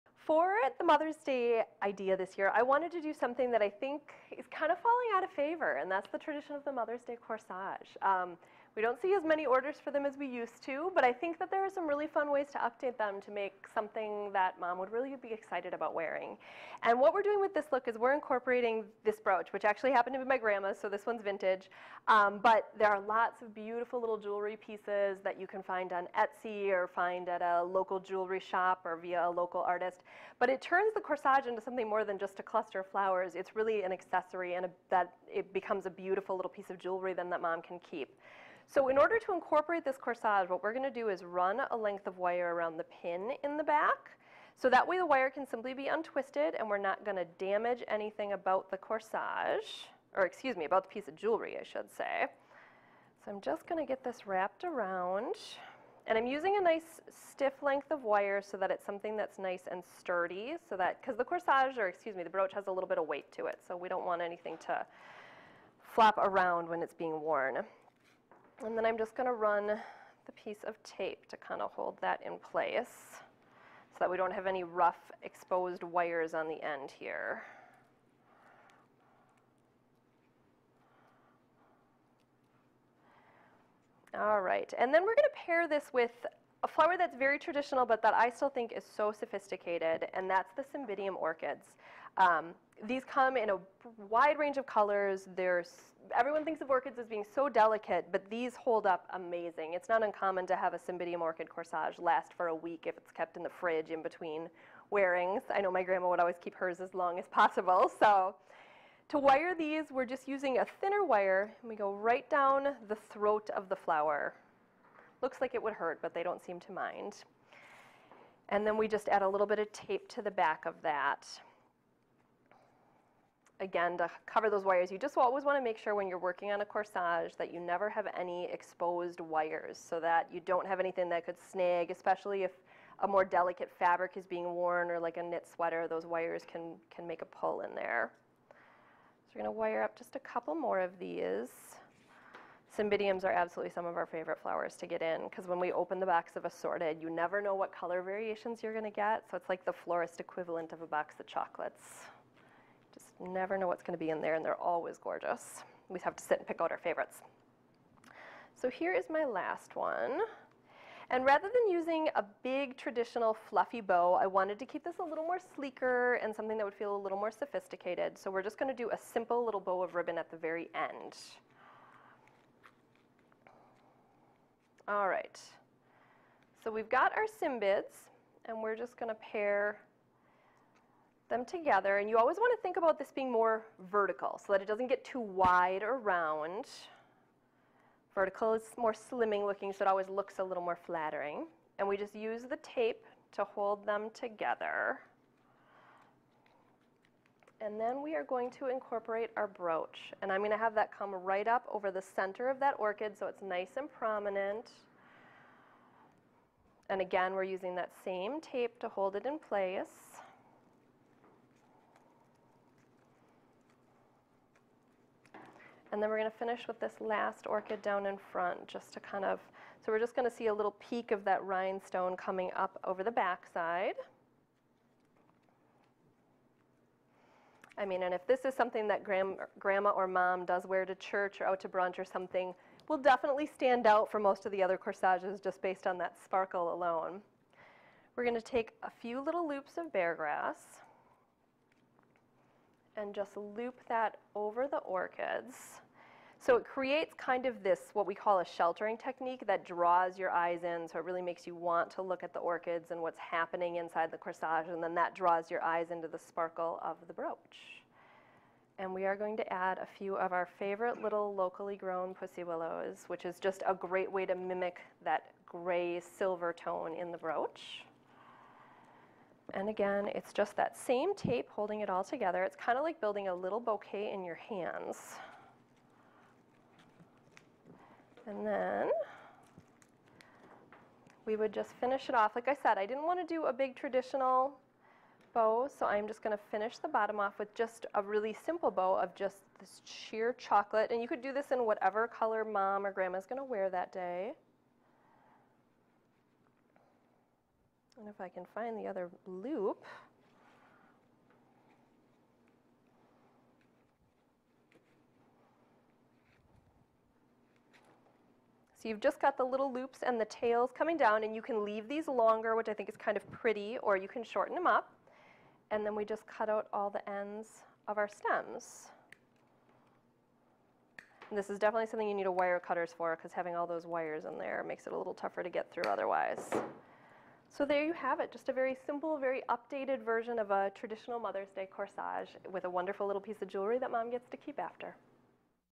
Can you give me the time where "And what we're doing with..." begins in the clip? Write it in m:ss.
0:16.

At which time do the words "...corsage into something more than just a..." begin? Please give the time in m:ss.
0:31.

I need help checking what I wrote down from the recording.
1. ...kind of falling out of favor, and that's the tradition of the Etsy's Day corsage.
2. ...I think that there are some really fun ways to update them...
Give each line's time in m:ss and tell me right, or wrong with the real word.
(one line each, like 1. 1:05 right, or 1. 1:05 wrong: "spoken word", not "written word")
1. 0:04 wrong: "Mother", not "Etsy"
2. 0:11 right.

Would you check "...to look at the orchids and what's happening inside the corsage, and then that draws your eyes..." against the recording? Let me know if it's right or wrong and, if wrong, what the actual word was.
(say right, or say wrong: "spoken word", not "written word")
right.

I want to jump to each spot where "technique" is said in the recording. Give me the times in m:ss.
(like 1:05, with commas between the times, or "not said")
4:08.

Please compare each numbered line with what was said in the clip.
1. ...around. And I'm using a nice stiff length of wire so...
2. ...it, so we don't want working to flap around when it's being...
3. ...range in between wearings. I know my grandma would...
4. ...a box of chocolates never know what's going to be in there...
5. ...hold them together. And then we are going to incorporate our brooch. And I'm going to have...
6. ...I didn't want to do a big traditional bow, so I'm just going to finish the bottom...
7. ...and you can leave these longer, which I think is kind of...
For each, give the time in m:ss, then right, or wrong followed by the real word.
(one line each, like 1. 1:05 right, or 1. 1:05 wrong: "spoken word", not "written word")
1. 0:54 right
2. 1:03 wrong: "anything", not "working"
3. 1:43 wrong: "fridge", not "range"
4. 2:30 right
5. 3:13 right
6. 4:42 right
7. 5:11 right.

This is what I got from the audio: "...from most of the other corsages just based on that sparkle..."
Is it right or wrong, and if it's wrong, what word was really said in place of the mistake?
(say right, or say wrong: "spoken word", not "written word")
right.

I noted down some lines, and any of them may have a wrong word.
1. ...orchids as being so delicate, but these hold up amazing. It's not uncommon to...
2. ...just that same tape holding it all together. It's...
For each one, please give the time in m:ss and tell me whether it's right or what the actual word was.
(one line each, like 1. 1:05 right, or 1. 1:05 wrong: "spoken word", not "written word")
1. 1:36 right
2. 4:30 right.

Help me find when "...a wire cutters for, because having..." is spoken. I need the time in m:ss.
5:22.